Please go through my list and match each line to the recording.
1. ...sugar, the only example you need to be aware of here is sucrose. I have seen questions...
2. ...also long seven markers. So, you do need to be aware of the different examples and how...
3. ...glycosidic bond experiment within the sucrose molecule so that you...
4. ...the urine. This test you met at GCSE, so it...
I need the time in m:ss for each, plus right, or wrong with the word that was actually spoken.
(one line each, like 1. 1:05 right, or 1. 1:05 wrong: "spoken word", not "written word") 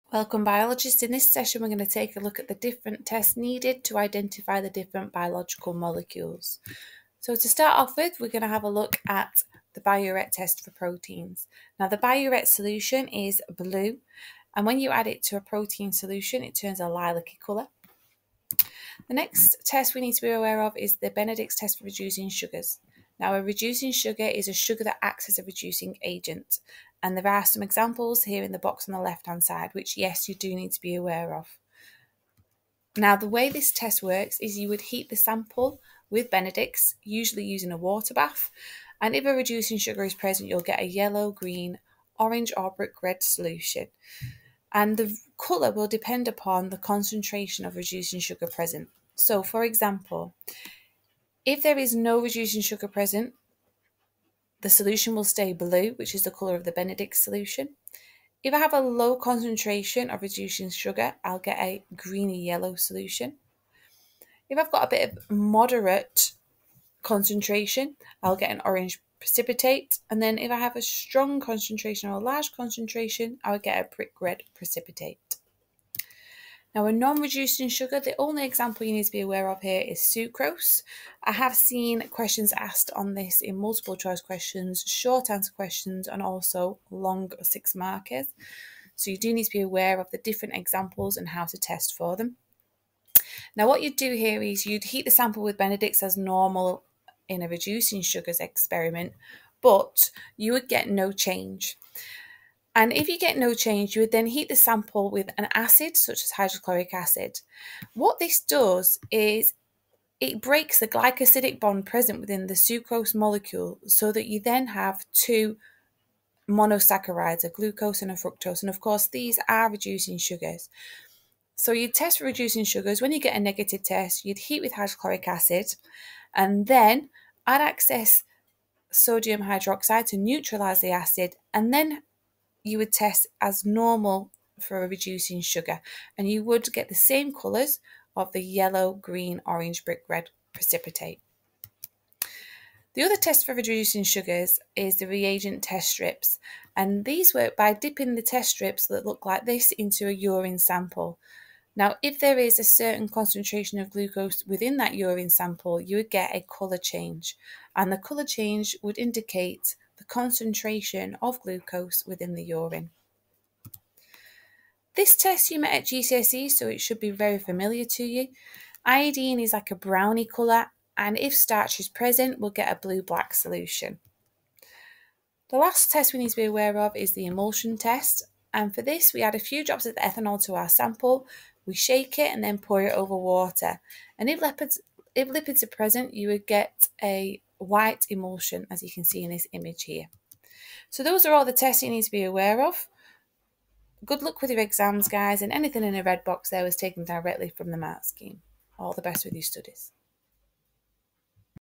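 1. 1:17 right
2. 1:26 wrong: "six", not "seven"
3. 1:50 wrong: "present", not "experiment"
4. 2:42 right.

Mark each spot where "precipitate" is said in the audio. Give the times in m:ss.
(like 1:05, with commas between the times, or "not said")
1:09, 1:14, 2:20.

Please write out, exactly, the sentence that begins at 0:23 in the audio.
Now, a reducing sugar is a sugar that acts as a reducing agent.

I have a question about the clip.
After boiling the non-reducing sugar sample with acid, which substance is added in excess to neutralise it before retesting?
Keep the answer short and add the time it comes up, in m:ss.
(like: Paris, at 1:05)
Sodium hydroxide, at 2:08.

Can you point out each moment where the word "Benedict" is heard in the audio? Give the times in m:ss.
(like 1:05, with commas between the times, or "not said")
0:21, 0:36, 0:56, 1:35.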